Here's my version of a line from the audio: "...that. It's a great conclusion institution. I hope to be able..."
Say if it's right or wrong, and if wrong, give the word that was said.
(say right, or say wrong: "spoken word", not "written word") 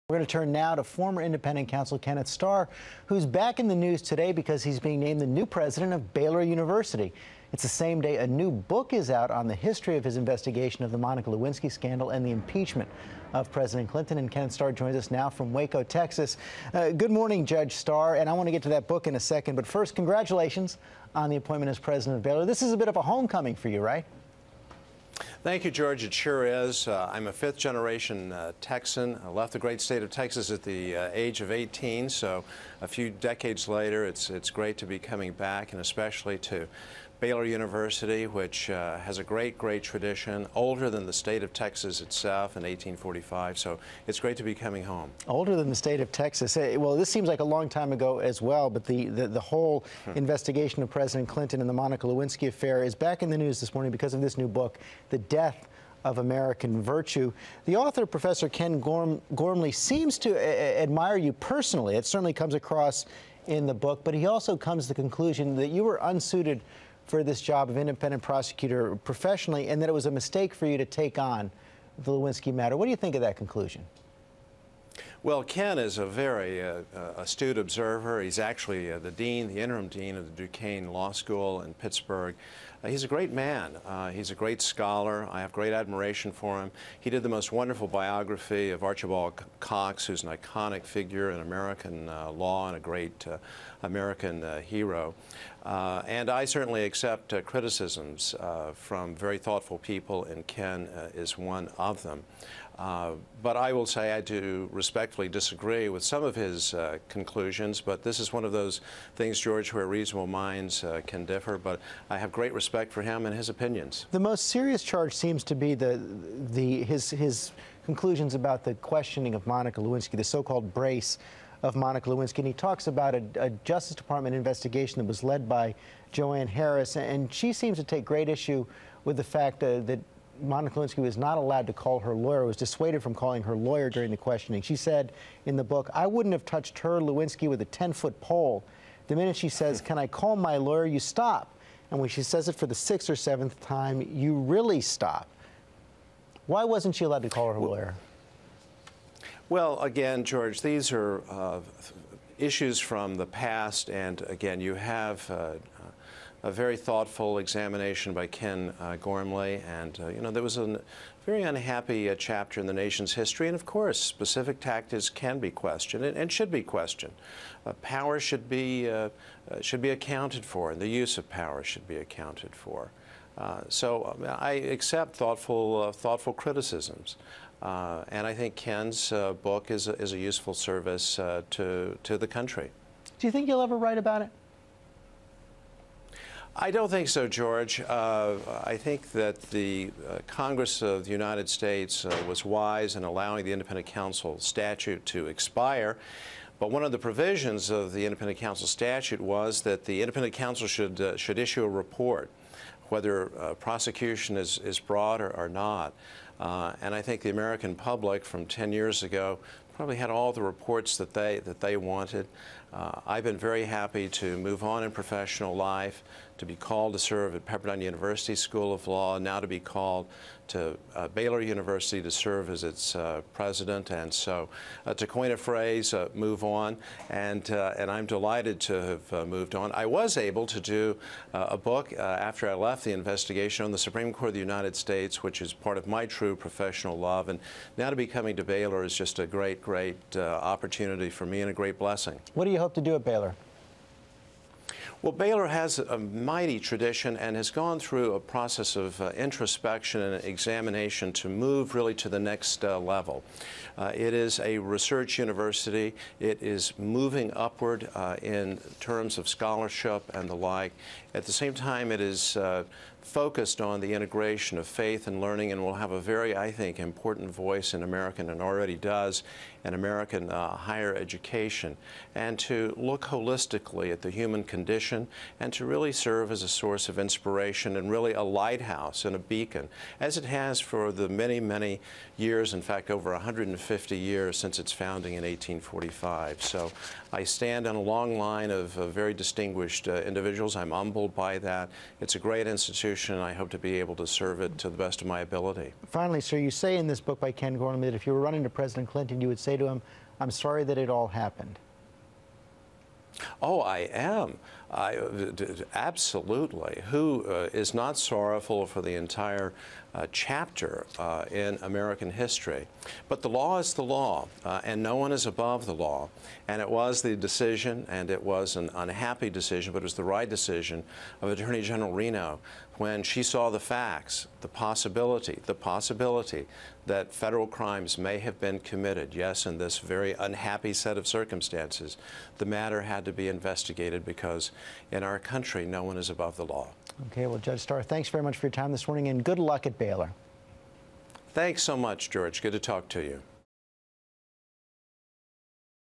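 wrong: "institution", not "conclusion".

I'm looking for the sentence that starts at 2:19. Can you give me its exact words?
The minute she says, Can I call my lawyer?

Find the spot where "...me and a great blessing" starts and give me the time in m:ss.
4:01.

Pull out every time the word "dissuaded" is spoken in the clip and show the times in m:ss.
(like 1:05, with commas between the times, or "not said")
2:12.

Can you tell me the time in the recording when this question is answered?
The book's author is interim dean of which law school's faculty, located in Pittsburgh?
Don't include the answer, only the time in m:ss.
1:20.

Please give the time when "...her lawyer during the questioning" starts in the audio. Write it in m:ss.
2:13.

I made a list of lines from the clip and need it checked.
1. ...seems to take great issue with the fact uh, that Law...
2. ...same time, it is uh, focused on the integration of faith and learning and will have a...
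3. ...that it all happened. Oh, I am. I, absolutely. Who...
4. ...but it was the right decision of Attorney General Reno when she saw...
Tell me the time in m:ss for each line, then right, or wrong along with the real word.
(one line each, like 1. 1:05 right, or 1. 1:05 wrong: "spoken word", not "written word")
1. 2:07 wrong: "Monica", not "Law"
2. 4:21 right
3. 5:00 right
4. 5:19 right.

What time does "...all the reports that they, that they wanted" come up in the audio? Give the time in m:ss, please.
3:30.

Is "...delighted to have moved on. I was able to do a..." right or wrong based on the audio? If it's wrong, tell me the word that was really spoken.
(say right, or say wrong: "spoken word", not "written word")
right.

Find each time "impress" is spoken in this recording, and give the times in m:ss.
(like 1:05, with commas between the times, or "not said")
not said.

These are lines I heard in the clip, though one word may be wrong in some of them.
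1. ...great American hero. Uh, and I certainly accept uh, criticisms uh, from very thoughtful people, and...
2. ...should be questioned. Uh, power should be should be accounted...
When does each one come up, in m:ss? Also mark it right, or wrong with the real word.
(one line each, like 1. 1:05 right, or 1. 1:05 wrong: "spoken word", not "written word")
1. 1:32 right
2. 2:46 right.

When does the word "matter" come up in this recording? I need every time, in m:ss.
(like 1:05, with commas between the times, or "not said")
1:12, 5:32.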